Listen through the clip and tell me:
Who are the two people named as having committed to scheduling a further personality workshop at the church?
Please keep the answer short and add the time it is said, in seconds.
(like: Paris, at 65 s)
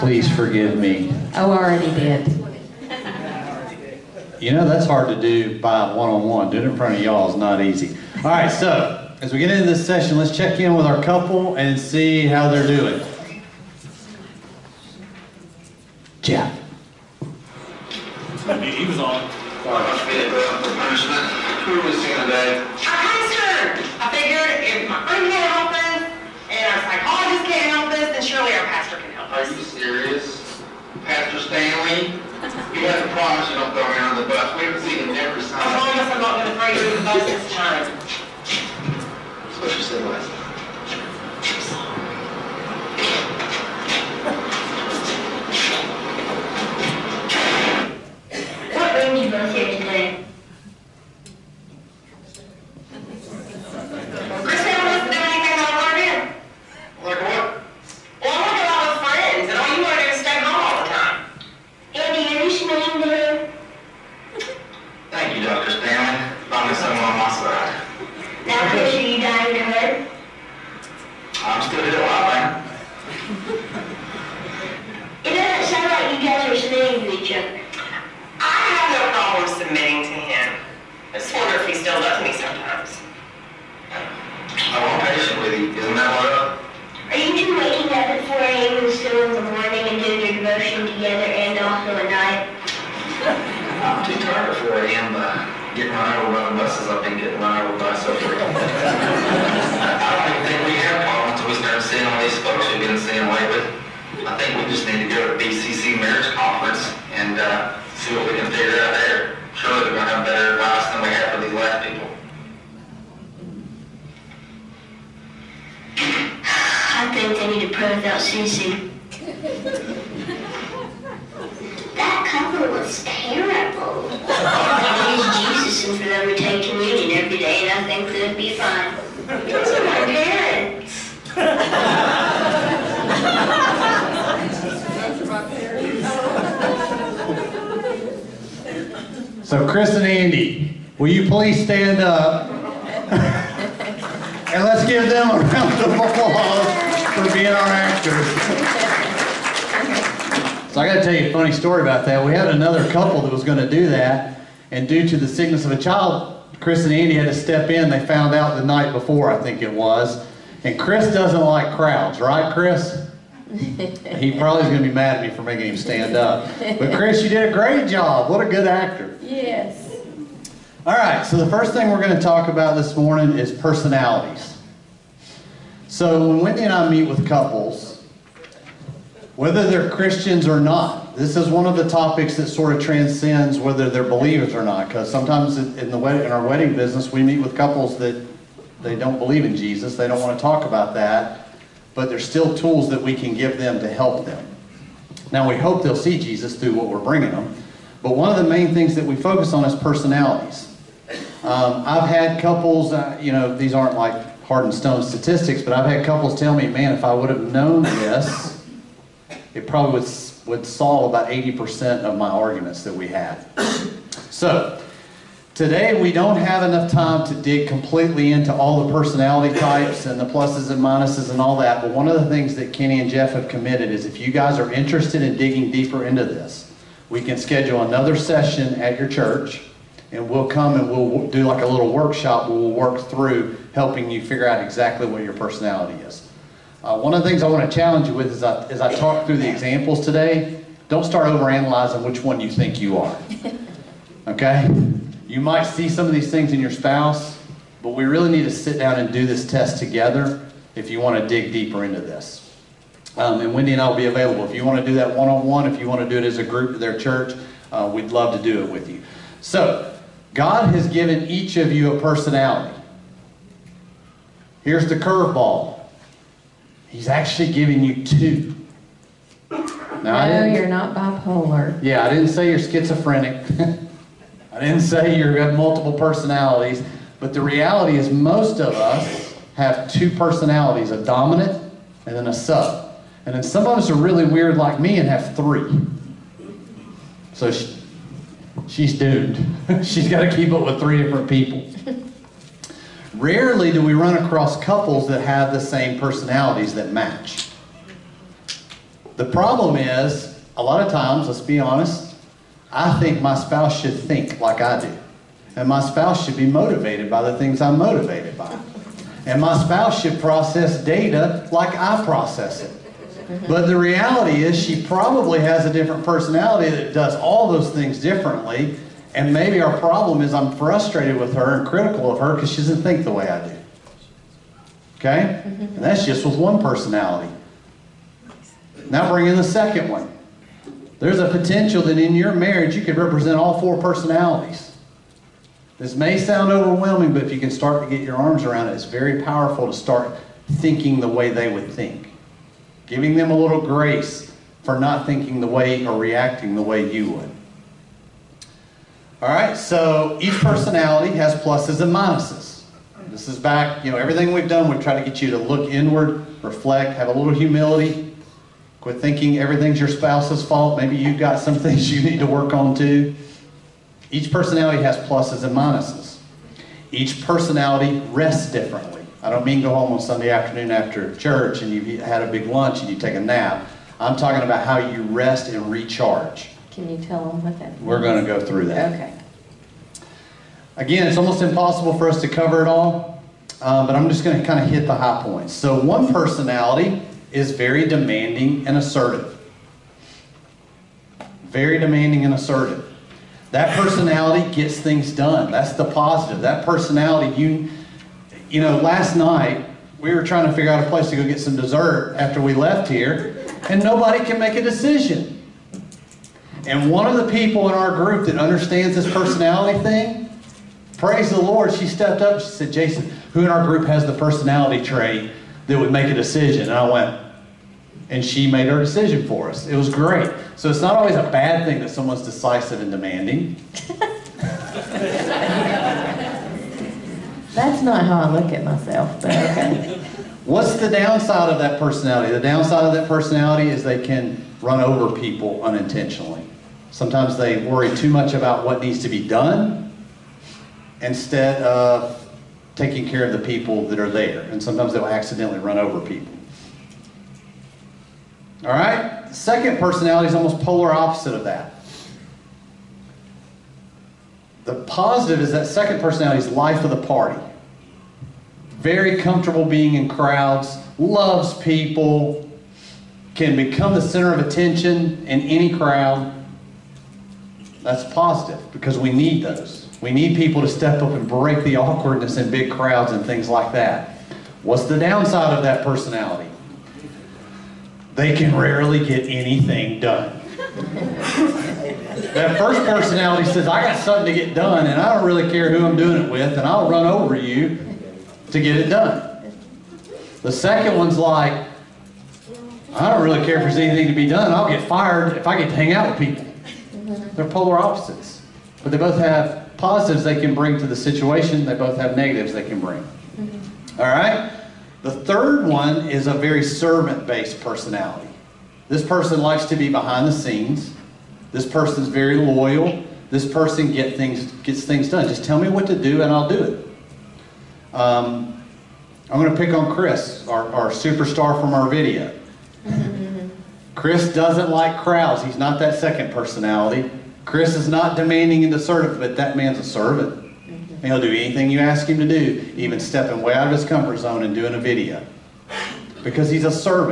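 Kenny and Jeff, at 222 s.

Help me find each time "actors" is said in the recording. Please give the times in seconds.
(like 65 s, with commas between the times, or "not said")
147 s, 168 s.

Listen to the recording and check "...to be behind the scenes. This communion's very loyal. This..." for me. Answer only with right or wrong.
wrong.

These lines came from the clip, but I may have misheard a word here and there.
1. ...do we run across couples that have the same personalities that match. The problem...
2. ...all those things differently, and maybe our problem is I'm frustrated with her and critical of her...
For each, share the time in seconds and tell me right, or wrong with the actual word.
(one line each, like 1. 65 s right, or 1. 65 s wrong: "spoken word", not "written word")
1. 293 s right
2. 317 s right.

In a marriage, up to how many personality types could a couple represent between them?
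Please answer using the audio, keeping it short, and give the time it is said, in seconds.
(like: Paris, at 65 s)
4, at 333 s.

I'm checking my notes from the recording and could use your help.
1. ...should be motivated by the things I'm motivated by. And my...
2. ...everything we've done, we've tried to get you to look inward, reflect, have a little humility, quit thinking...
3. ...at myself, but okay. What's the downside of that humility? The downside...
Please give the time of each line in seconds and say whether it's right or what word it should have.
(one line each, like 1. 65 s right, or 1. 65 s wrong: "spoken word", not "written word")
1. 306 s right
2. 353 s right
3. 428 s wrong: "personality", not "humility".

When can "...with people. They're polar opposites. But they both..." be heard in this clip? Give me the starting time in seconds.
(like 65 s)
496 s.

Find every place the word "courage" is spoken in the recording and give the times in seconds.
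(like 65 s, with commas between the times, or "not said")
not said.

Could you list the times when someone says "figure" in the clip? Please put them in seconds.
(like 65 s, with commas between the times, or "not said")
234 s, 400 s.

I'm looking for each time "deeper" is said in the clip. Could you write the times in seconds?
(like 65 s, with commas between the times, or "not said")
225 s, 251 s.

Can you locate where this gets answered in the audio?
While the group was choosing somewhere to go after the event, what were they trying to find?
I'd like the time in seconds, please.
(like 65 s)
401 s.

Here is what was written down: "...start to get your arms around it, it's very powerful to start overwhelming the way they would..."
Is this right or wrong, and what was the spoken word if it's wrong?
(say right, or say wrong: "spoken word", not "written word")
wrong: "thinking", not "overwhelming".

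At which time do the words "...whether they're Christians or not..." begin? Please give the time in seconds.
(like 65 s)
179 s.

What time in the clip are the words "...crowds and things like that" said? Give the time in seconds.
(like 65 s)
472 s.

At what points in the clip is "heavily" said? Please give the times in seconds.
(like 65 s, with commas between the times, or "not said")
not said.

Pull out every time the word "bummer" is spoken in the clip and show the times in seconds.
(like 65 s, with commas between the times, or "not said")
not said.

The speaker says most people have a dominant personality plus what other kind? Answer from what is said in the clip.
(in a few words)
a sub.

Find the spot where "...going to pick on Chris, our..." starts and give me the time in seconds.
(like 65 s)
519 s.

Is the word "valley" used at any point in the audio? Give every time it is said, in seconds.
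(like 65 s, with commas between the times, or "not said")
not said.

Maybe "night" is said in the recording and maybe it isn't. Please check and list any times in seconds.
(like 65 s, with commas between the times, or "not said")
158 s, 399 s.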